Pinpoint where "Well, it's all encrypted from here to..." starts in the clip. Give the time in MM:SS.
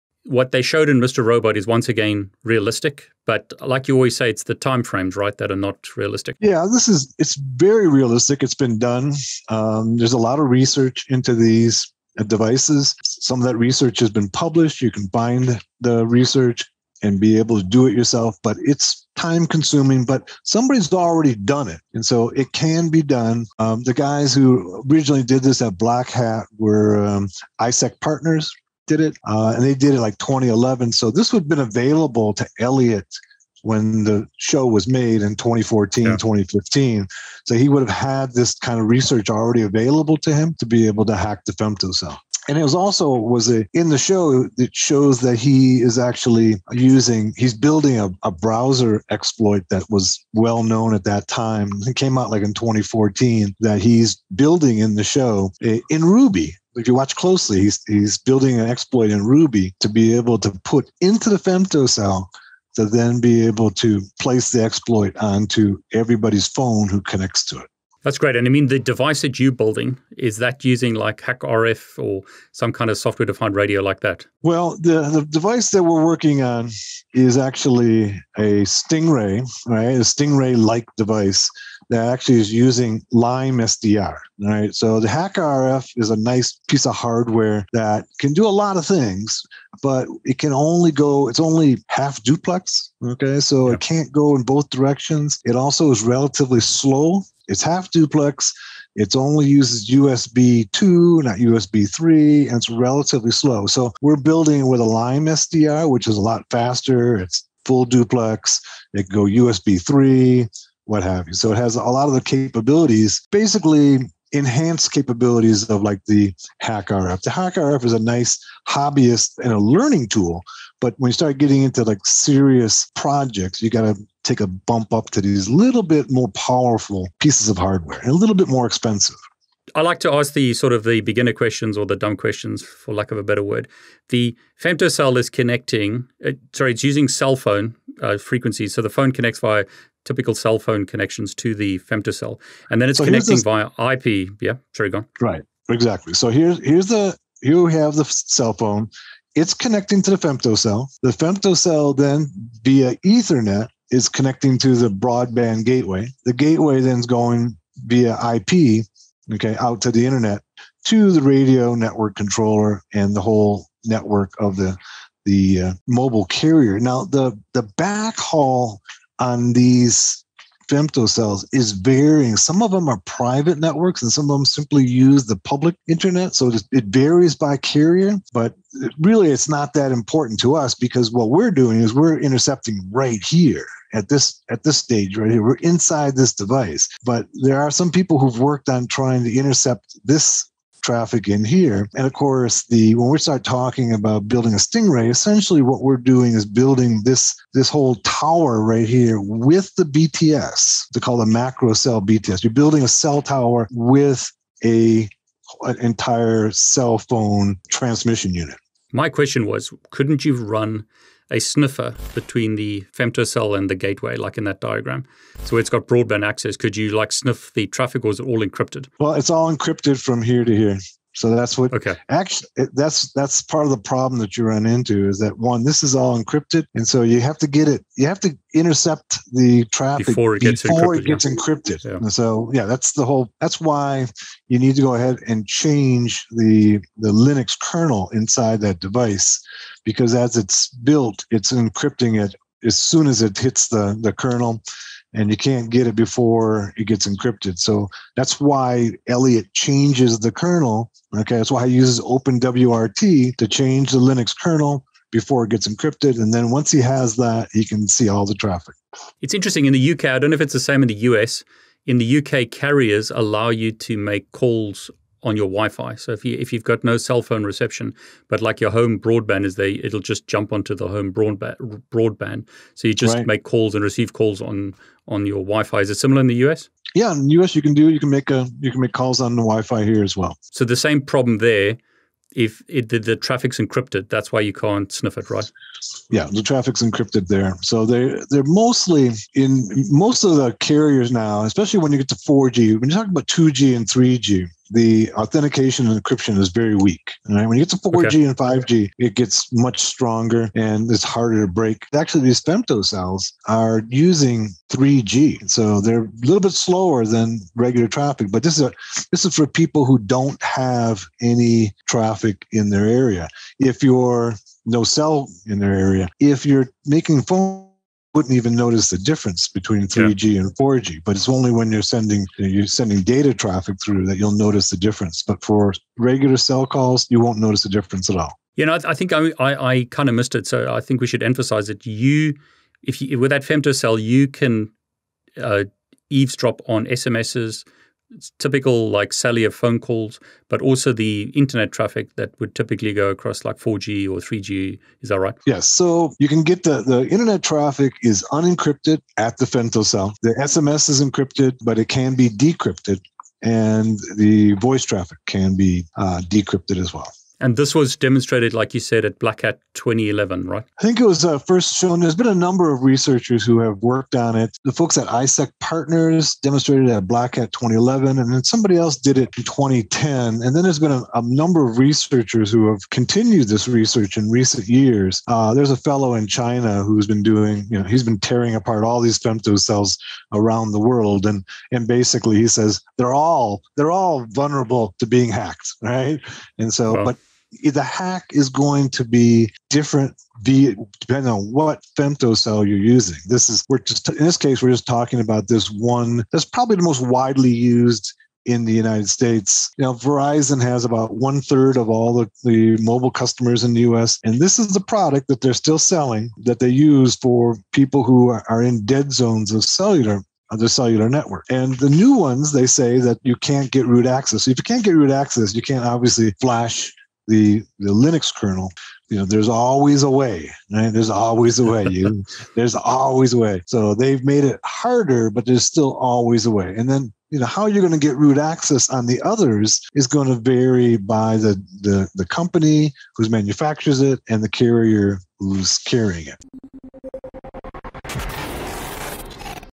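03:38.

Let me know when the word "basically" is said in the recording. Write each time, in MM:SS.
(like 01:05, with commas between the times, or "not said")
01:53, 06:21.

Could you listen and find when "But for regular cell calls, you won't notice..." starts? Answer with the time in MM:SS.
05:25.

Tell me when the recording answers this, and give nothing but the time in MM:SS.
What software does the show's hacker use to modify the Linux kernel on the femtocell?
04:11.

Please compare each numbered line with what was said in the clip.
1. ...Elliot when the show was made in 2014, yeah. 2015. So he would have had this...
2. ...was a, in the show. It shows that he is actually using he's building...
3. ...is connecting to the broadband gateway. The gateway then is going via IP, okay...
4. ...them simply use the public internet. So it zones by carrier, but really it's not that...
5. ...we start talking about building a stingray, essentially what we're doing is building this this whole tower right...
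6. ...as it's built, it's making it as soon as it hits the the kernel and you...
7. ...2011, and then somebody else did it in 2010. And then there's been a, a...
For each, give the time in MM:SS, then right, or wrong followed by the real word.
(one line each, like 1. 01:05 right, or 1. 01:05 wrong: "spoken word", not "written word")
1. 00:32 right
2. 00:43 right
3. 02:33 right
4. 02:54 wrong: "varies", not "zones"
5. 03:13 right
6. 04:00 wrong: "encrypting", not "making"
7. 06:07 right.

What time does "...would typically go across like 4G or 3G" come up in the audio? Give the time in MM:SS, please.
05:42.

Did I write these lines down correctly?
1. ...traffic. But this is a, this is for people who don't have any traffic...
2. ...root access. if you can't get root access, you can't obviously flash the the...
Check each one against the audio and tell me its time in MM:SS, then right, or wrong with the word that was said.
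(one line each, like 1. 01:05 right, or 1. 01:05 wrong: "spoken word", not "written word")
1. 05:07 right
2. 06:53 right.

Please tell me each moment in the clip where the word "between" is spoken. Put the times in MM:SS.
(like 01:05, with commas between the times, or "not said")
03:32, 05:19.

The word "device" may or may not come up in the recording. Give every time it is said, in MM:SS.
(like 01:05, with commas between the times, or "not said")
00:12, 01:08, 01:15, 01:20, 03:06, 03:58.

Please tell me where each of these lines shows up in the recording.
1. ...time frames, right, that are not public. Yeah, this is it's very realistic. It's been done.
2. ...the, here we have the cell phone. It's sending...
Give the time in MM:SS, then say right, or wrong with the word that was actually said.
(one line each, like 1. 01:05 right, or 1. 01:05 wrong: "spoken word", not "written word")
1. 00:04 wrong: "realistic", not "public"
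2. 02:26 wrong: "connecting", not "sending".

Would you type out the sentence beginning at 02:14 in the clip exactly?
The femtocell is connecting, uh, sorry, it's using cell phone uh, frequencies.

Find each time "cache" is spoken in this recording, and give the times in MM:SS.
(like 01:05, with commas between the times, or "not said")
not said.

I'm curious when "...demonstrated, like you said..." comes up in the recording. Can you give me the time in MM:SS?
05:57.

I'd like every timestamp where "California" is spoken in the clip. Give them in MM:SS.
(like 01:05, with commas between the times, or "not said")
not said.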